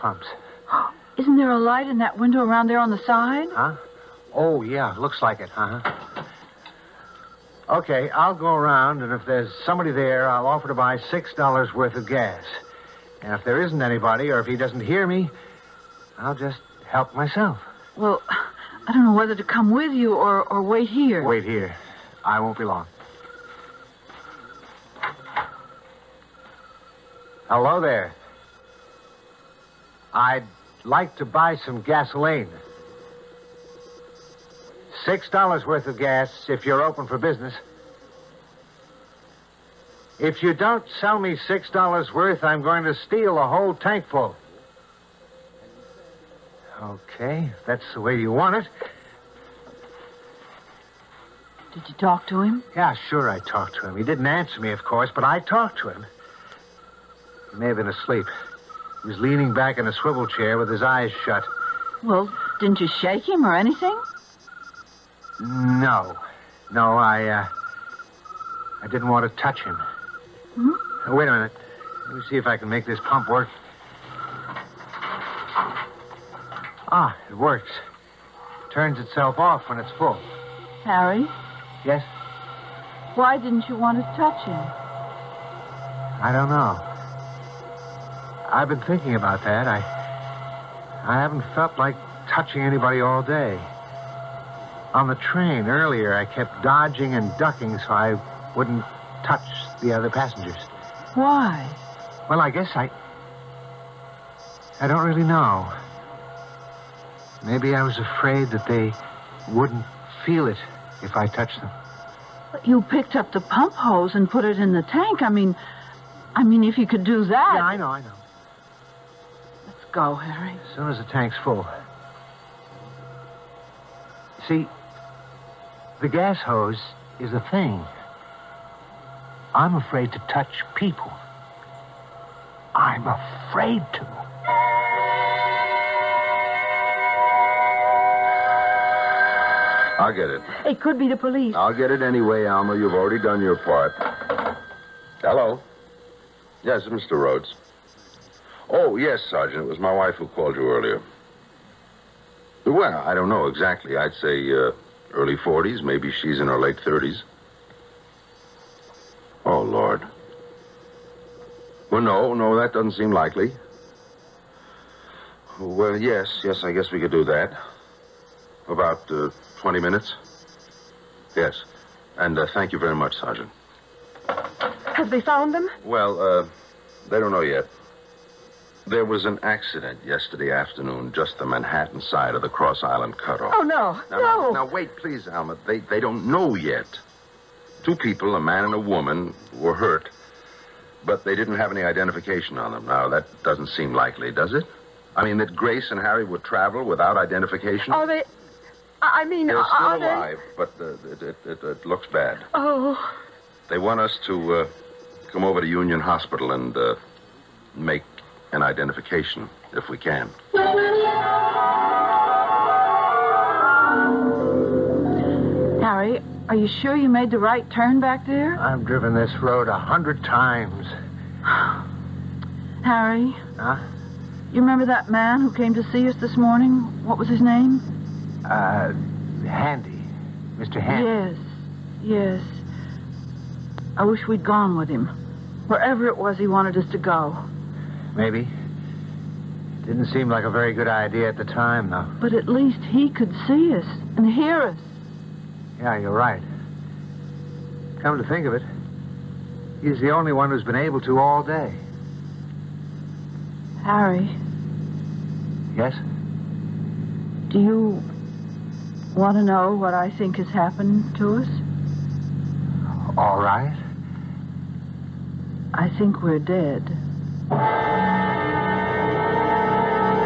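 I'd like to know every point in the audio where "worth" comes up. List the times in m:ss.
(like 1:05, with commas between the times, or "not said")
0:11, 0:35, 0:42.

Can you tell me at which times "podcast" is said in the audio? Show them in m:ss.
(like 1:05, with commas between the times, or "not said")
not said.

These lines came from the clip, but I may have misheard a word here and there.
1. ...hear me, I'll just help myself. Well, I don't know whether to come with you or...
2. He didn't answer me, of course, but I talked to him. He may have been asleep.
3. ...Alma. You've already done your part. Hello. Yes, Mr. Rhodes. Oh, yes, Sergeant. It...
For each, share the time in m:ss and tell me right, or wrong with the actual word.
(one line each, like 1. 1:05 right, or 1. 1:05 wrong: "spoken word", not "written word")
1. 0:14 right
2. 0:53 right
3. 2:22 right.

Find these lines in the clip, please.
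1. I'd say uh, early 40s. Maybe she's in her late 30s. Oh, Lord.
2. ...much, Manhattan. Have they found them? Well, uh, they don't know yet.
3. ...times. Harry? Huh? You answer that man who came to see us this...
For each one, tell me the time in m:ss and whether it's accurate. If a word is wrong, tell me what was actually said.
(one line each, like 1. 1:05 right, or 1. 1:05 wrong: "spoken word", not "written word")
1. 2:33 right
2. 2:52 wrong: "Sergeant", not "Manhattan"
3. 3:40 wrong: "remember", not "answer".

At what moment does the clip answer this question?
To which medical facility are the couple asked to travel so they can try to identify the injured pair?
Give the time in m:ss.
3:25.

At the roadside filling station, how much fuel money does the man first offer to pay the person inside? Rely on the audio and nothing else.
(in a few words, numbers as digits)
$6.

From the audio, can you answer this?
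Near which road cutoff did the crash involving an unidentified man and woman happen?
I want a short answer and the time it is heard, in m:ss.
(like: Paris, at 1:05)
Cross Island cutoff, at 3:02.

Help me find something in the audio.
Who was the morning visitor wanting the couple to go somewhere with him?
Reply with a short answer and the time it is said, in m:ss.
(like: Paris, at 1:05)
Mr. Handy, at 3:50.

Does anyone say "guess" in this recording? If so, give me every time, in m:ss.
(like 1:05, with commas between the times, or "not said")
1:42, 2:46.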